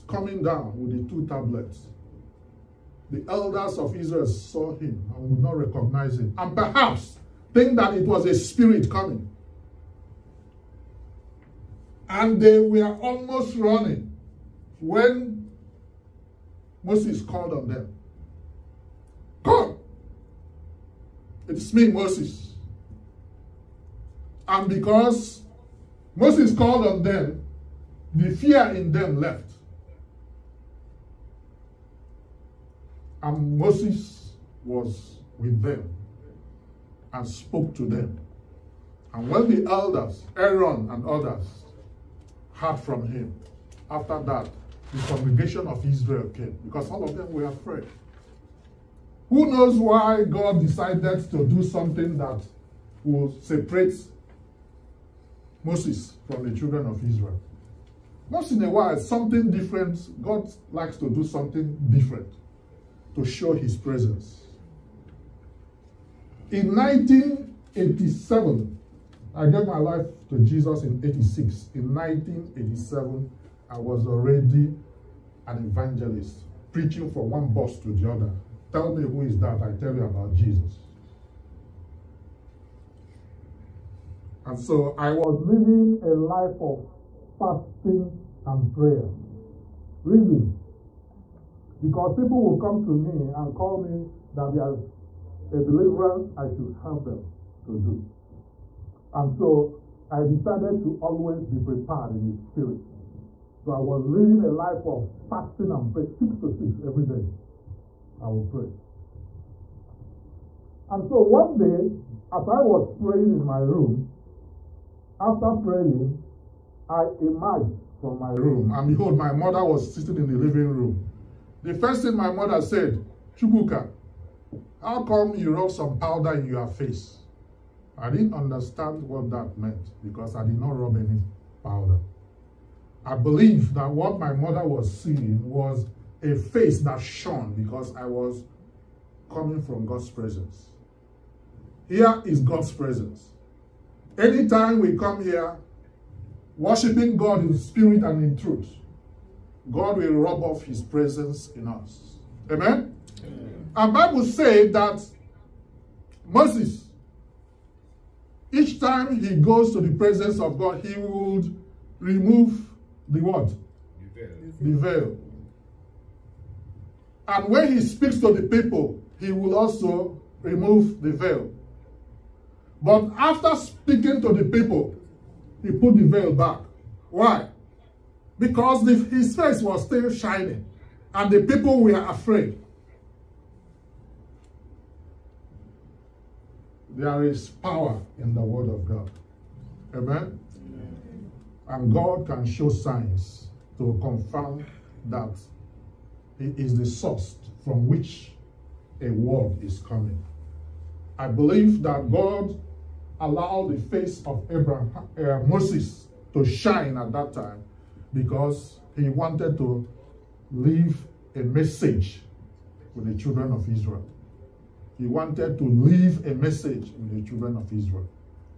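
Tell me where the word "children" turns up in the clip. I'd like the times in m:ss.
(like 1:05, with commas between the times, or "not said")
0:56, 3:33, 3:37.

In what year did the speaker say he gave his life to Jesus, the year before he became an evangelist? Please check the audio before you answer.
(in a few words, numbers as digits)
1986.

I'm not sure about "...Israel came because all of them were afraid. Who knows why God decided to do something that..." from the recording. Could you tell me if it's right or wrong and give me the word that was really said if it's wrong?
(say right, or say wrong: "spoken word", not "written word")
right.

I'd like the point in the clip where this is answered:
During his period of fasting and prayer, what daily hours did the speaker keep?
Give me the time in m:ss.
1:46.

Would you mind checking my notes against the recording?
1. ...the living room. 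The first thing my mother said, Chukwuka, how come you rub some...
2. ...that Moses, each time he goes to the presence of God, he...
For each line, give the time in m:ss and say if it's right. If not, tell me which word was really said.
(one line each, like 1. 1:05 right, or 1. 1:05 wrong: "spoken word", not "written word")
1. 2:00 right
2. 2:34 right.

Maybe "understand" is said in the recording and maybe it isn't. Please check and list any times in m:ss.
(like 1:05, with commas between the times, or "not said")
2:08.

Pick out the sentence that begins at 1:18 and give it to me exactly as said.
Tell me who is that, I tell you about Jesus.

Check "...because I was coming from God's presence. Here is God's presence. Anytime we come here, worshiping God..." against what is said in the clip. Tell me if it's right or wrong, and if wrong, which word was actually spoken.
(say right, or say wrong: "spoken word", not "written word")
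right.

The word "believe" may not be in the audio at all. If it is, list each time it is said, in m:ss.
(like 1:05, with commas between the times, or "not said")
2:13, 3:21.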